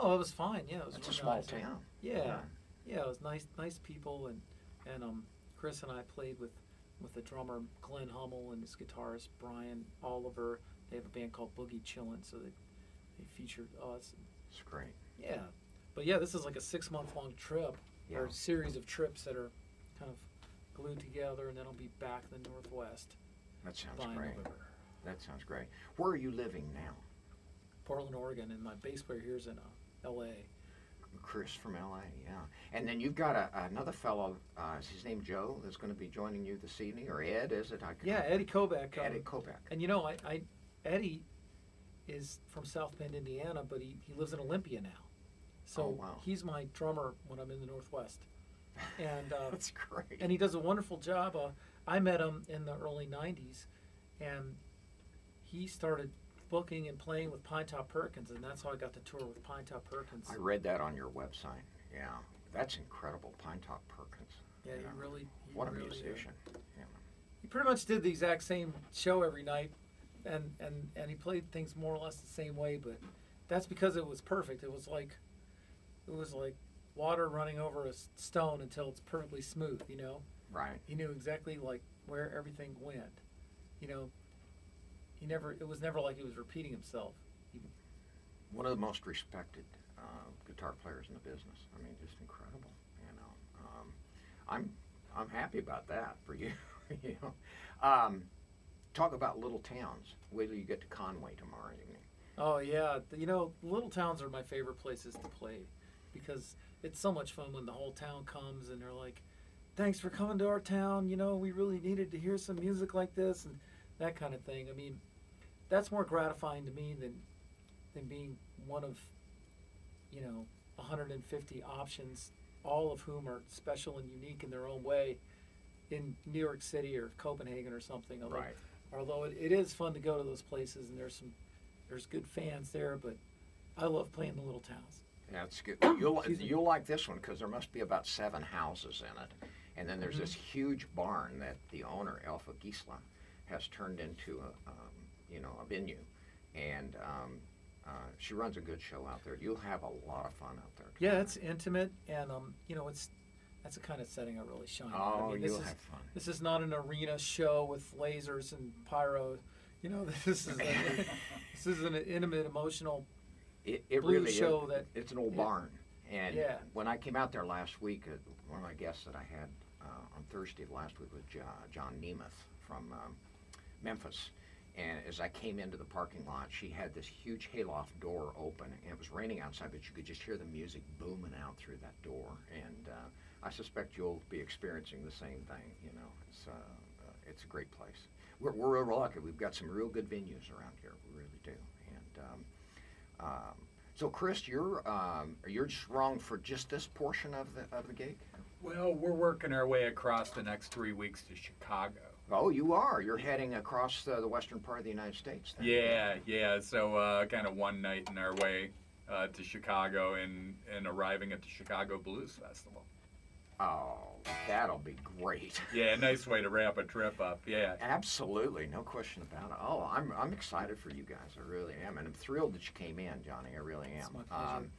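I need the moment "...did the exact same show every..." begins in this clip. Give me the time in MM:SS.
01:07.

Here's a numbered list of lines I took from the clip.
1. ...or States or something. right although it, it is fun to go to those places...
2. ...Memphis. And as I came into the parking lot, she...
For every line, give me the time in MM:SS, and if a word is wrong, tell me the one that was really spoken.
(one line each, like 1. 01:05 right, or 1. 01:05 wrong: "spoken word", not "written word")
1. 02:06 wrong: "Copenhagen", not "States"
2. 02:53 right.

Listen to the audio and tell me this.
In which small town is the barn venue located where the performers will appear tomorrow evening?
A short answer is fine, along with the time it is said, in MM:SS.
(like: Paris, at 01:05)
Conway, at 01:40.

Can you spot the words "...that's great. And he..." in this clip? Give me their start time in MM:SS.
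00:49.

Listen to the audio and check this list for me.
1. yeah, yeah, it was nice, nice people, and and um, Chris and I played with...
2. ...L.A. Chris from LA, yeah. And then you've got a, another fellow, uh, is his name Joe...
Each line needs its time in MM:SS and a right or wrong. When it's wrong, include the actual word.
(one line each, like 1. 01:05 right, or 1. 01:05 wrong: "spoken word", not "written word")
1. 00:02 right
2. 00:30 right.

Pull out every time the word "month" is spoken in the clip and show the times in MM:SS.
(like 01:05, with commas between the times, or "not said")
00:16.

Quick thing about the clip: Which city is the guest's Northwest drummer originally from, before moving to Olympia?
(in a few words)
South Bend, Indiana.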